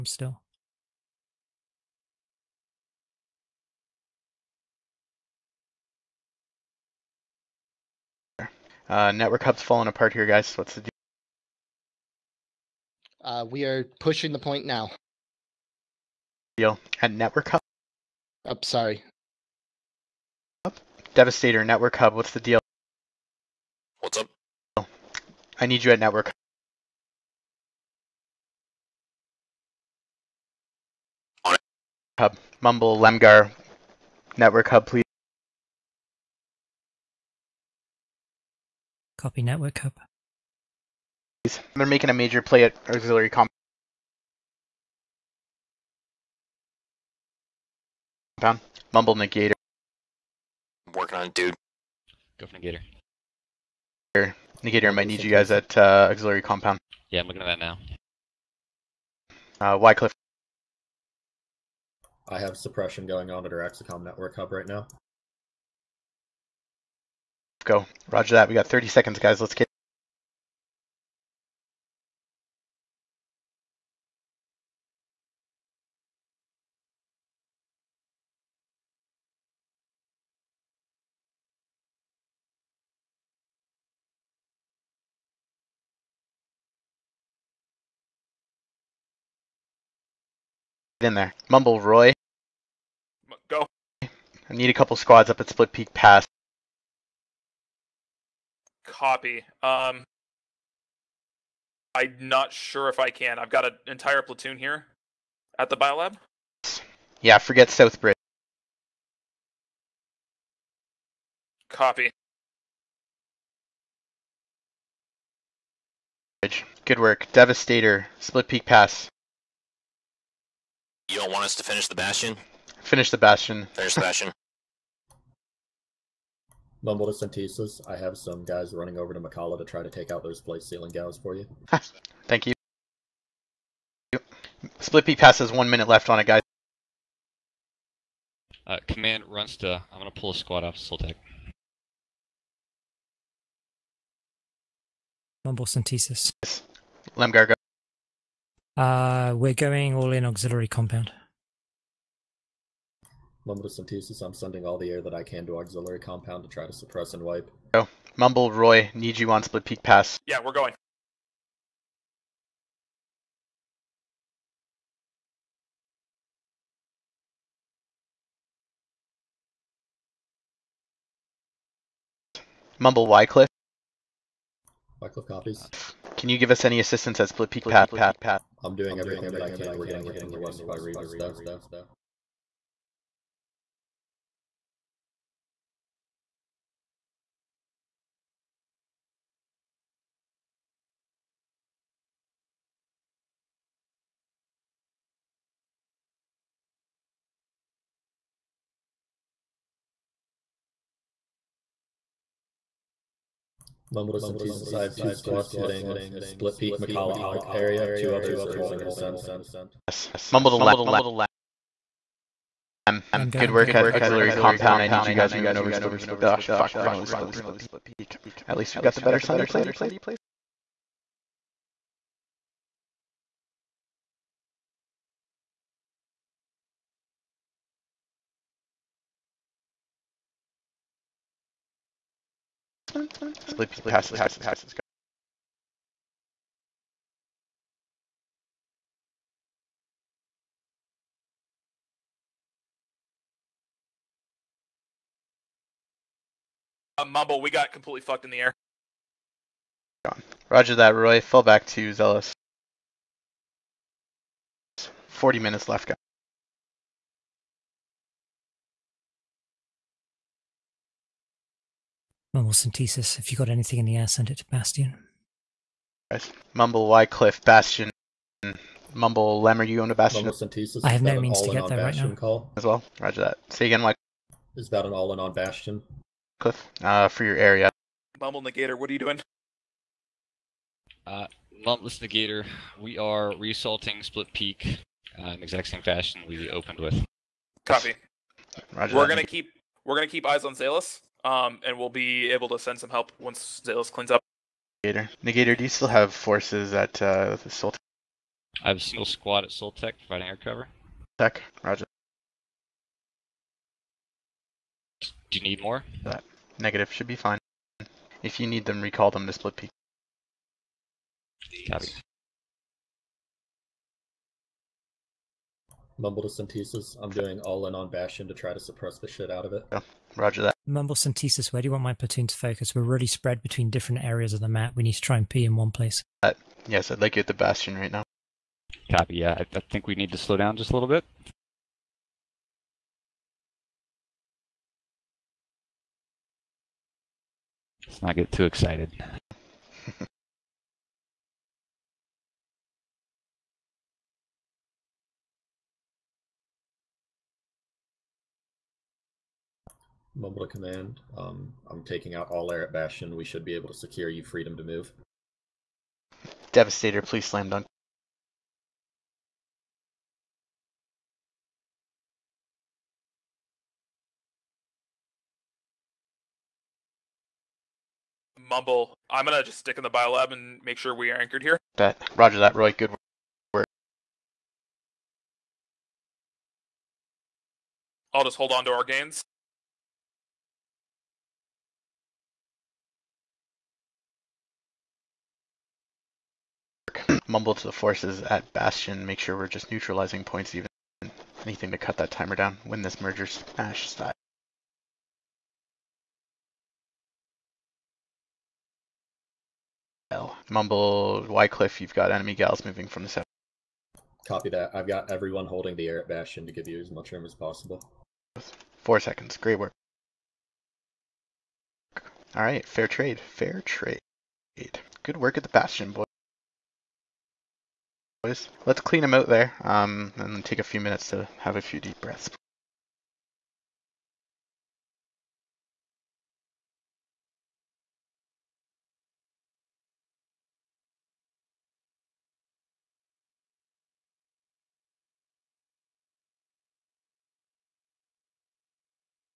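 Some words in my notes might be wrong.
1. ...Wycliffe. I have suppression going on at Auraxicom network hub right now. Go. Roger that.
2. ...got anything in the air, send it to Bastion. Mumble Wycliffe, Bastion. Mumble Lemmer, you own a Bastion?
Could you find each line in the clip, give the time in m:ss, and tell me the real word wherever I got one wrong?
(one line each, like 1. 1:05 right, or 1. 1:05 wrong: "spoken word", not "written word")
1. 0:59 right
2. 4:23 right.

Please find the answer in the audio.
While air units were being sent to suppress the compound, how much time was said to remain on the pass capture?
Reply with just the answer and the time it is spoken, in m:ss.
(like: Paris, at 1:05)
1 minute, at 2:15.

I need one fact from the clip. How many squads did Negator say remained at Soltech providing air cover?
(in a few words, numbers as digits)
1.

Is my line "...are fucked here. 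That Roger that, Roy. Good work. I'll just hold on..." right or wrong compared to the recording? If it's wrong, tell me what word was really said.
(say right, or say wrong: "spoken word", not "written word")
wrong: "anchored", not "fucked".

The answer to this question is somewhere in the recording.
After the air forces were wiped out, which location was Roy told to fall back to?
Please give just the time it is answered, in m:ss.
4:11.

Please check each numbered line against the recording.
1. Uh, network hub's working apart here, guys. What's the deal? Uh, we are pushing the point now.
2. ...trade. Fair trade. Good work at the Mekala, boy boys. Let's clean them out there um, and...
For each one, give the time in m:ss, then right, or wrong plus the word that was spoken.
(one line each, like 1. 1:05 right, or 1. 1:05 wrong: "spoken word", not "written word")
1. 0:08 wrong: "falling", not "working"
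2. 6:52 wrong: "Bastion", not "Mekala".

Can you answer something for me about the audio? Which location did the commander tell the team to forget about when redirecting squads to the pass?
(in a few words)
Southbridge.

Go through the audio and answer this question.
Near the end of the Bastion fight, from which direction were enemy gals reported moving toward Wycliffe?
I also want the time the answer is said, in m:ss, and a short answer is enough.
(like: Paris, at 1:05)
South, at 6:43.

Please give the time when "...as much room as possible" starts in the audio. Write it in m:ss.
6:46.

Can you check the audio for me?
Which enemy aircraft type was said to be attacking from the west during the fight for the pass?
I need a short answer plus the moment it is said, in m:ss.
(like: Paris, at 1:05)
Reavers, at 3:00.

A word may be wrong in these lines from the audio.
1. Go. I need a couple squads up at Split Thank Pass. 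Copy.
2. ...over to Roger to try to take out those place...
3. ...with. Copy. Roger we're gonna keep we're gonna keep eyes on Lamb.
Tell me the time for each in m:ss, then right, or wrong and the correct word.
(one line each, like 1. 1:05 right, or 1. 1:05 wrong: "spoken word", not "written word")
1. 1:33 wrong: "Peak", not "Thank"
2. 2:08 wrong: "Mekala", not "Roger"
3. 4:46 wrong: "Salus", not "Lamb".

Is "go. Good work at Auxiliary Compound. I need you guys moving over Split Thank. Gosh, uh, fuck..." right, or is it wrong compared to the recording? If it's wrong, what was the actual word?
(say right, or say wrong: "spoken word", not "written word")
wrong: "Peak", not "Thank".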